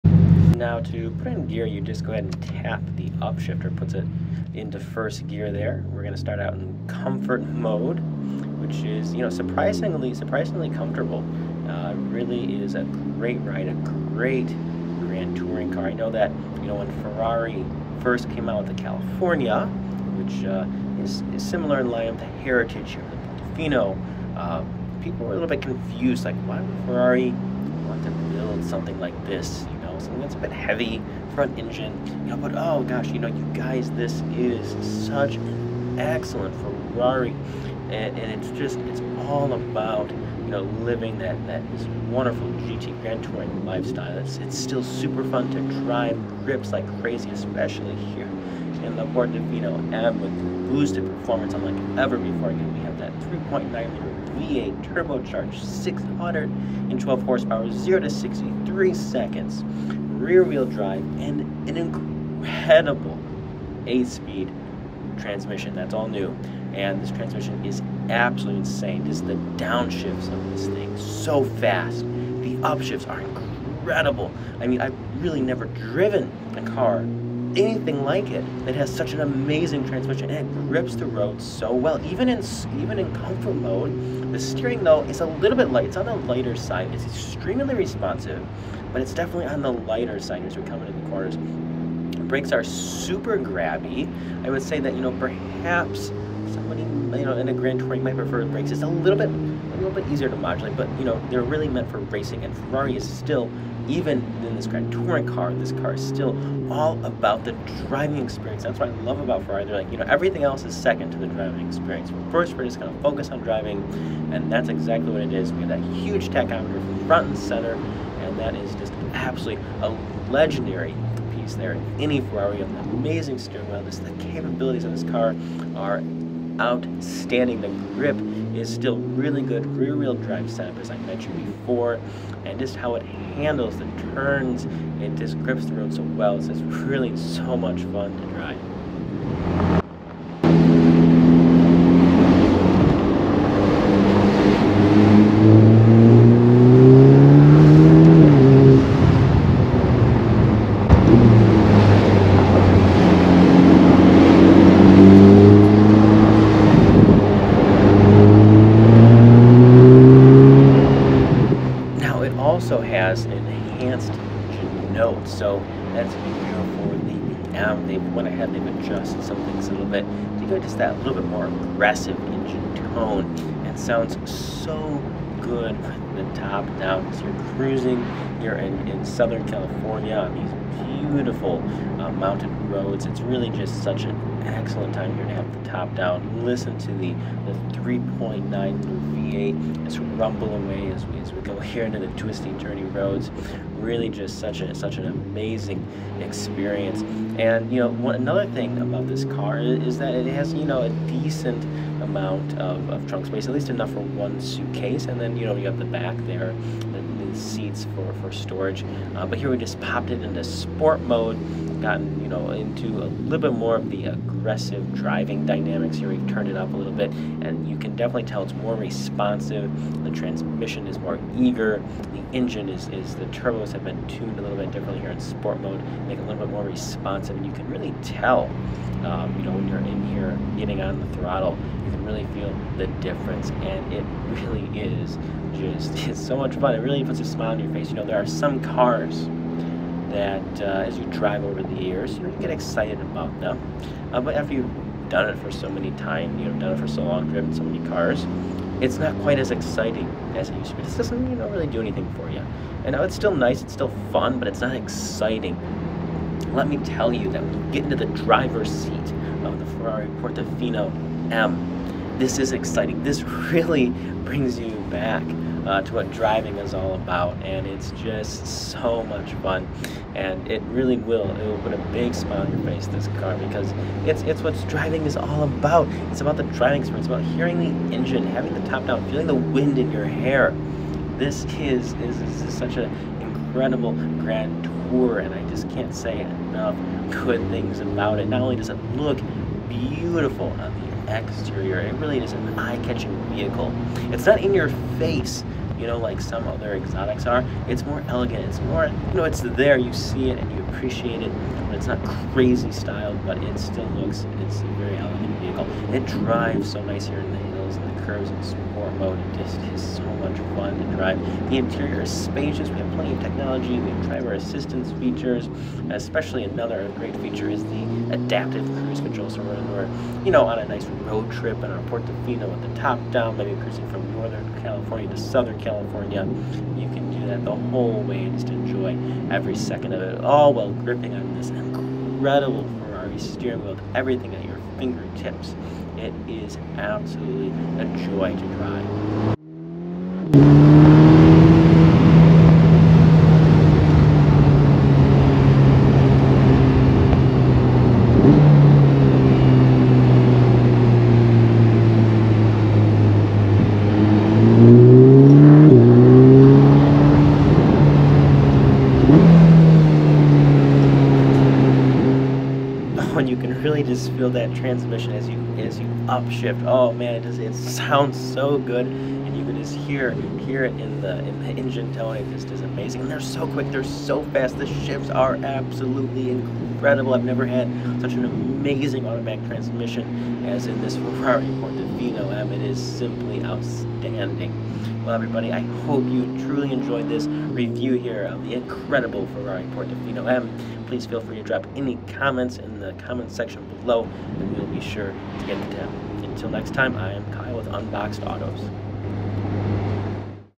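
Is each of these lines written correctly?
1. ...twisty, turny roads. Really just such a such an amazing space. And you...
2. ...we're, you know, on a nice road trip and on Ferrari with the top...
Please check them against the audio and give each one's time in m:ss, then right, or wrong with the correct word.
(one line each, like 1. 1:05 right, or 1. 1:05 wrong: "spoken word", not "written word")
1. 3:12 wrong: "experience", not "space"
2. 5:19 wrong: "Portofino", not "Ferrari".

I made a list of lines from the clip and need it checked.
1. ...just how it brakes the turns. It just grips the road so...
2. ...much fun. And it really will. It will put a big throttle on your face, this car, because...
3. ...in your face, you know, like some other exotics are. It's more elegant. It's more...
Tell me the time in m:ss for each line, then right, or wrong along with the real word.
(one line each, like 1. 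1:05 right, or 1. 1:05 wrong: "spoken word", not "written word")
1. 2:12 wrong: "handles", not "brakes"
2. 4:29 wrong: "smile", not "throttle"
3. 4:54 right.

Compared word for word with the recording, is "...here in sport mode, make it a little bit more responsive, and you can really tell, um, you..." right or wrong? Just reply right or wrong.
right.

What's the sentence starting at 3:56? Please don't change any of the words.
It really puts a smile on your face.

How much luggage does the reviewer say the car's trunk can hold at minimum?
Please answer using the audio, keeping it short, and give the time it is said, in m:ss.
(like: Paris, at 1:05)
one suitcase, at 3:24.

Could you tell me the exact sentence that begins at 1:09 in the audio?
Just the downshifts of this thing so fast.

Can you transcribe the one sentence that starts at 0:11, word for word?
Uh, really is a great ride, a great Grand Touring car.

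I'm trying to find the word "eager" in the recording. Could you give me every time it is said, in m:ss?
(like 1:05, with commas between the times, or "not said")
3:41.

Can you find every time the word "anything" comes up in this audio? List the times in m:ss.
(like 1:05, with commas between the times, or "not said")
1:17, 4:11.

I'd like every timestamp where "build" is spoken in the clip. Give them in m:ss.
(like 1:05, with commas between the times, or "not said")
0:28.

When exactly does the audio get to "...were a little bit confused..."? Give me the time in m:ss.
0:25.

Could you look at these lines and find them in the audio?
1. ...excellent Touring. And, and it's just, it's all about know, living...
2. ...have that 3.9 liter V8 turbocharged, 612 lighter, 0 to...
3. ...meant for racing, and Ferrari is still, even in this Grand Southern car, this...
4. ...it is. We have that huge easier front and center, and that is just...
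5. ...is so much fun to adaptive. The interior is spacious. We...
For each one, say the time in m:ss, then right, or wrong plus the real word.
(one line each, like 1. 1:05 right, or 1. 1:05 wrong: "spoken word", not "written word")
1. 0:35 wrong: "Ferrari", not "Touring"
2. 0:52 wrong: "horsepower", not "lighter"
3. 1:41 wrong: "Touring", not "Southern"
4. 1:55 wrong: "tachometer", not "easier"
5. 5:09 wrong: "drive", not "adaptive".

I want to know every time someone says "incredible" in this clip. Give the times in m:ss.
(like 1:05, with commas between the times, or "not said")
1:01, 1:13, 4:43, 5:32, 6:16, 6:28.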